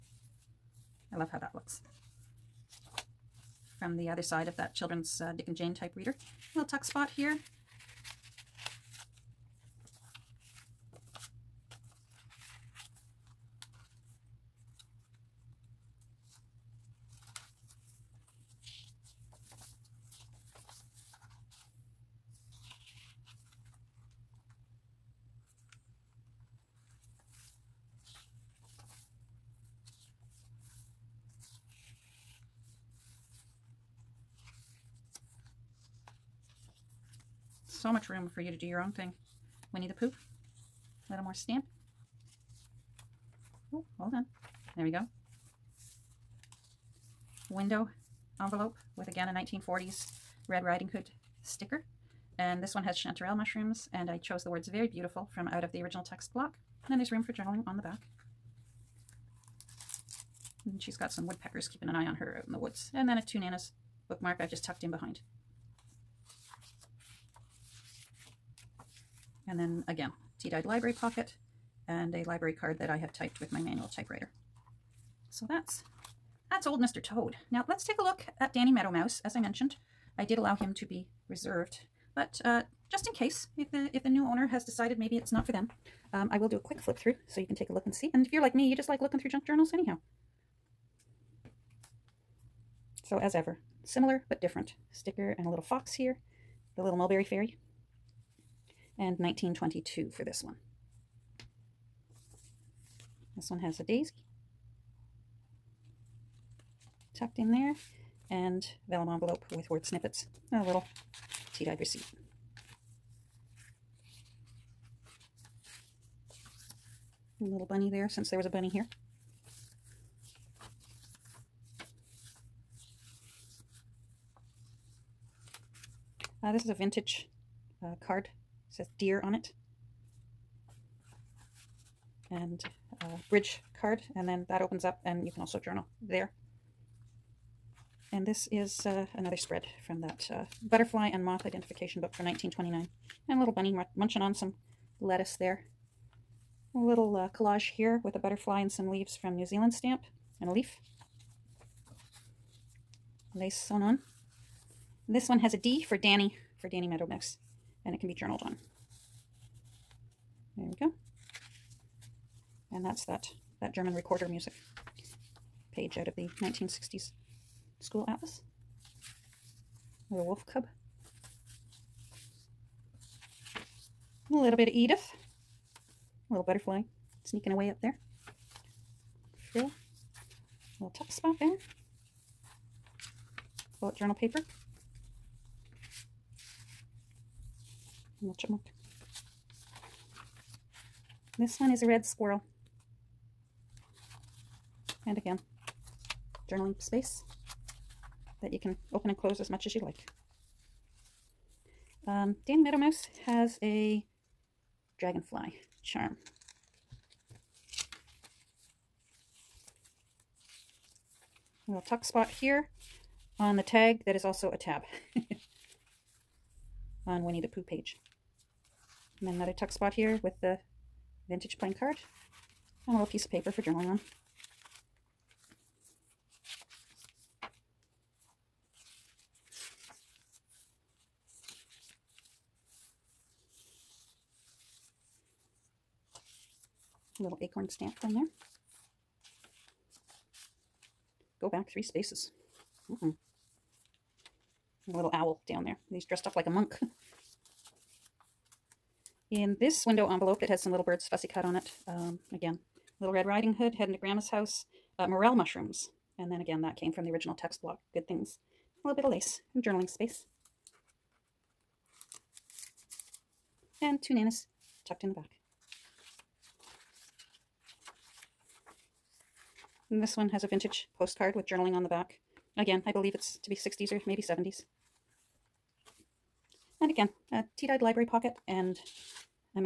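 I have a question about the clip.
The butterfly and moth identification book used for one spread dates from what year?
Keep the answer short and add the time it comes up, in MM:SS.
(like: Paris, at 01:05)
1929, at 02:22.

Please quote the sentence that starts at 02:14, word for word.
And then that opens up and you can also journal there.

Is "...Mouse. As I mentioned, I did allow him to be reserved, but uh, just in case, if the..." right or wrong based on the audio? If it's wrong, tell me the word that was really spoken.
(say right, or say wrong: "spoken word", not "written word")
right.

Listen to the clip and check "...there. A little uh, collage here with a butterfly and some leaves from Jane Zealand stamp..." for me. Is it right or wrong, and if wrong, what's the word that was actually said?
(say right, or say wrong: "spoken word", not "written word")
wrong: "New", not "Jane".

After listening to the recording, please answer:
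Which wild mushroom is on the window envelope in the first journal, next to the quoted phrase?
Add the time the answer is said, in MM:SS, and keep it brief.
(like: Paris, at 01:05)
chanterelle, at 00:52.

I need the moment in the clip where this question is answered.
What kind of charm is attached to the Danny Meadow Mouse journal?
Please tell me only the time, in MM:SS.
03:24.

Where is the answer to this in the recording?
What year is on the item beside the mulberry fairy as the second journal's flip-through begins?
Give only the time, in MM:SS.
01:39.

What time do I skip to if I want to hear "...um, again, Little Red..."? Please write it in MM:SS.
04:11.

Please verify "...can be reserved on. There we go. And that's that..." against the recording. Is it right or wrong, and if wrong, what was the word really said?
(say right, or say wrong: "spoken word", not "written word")
wrong: "journaled", not "reserved".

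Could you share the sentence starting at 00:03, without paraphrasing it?
From the other side of that children's uh, Dick and Jane type reader.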